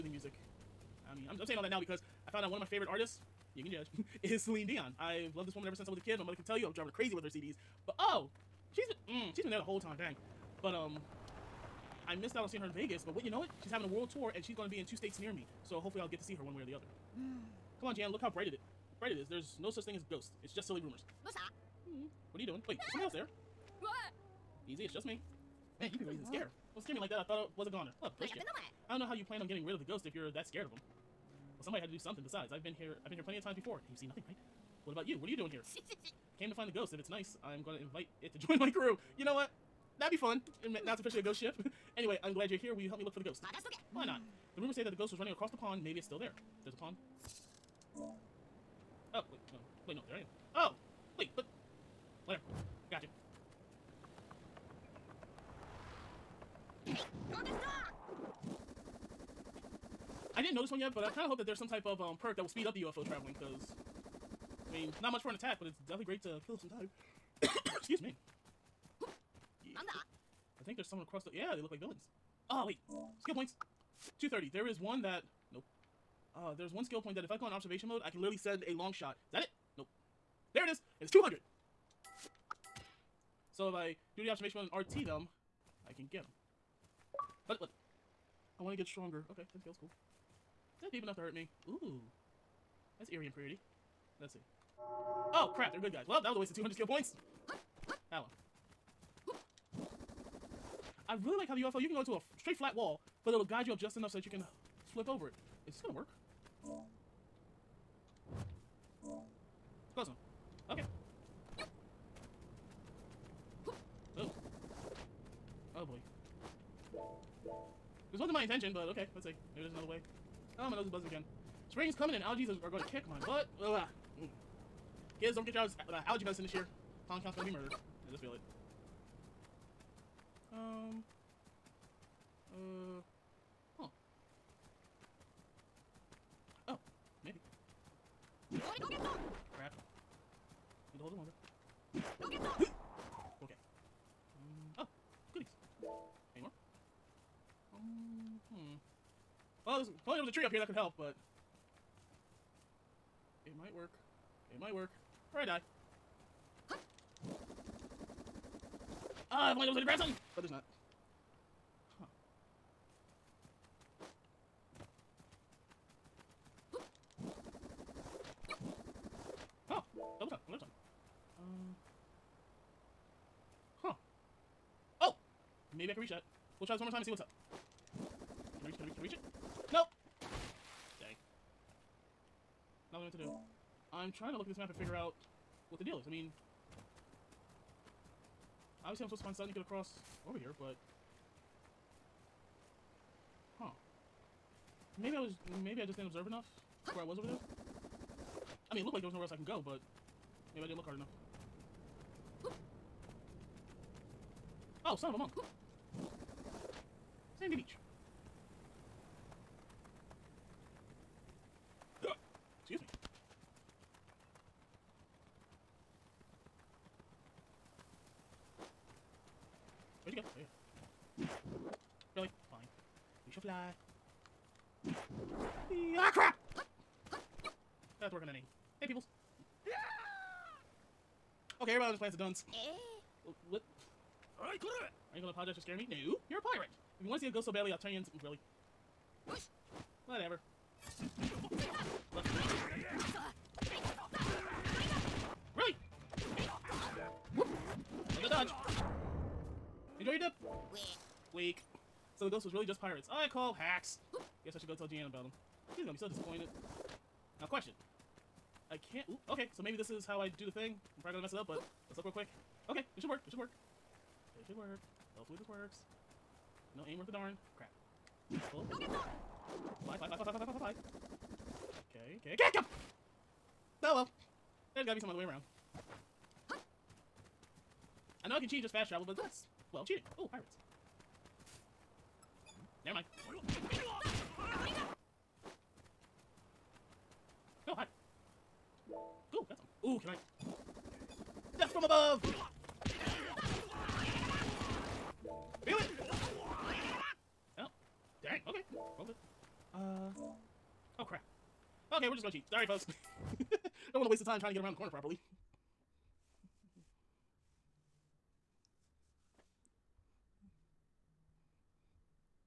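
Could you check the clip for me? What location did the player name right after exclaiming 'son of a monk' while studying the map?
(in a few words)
Sandy Beach.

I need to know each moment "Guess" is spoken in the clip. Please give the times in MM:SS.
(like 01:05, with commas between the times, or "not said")
04:14.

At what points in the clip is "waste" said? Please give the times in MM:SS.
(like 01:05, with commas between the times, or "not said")
01:36, 05:04.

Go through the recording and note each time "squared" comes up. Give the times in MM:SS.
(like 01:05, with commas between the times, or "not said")
not said.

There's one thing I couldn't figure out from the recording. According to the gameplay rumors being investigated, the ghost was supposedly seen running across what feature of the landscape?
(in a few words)
the pond.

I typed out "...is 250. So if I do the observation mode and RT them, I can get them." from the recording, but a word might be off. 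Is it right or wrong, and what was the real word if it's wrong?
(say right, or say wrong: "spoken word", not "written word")
wrong: "200", not "250".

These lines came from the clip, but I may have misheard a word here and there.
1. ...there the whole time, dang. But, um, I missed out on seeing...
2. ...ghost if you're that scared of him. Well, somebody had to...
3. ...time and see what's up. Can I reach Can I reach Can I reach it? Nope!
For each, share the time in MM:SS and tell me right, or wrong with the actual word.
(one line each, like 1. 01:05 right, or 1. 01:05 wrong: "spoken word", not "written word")
1. 00:09 right
2. 00:29 right
3. 02:56 right.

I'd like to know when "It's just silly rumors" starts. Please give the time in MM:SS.
00:20.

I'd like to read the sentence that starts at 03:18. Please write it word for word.
I mean, it looked like there was nowhere else I can go, but maybe I didn't look hard enough.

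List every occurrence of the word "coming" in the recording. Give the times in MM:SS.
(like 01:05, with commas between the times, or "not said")
02:01.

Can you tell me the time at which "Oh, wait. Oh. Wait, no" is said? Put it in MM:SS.
00:49.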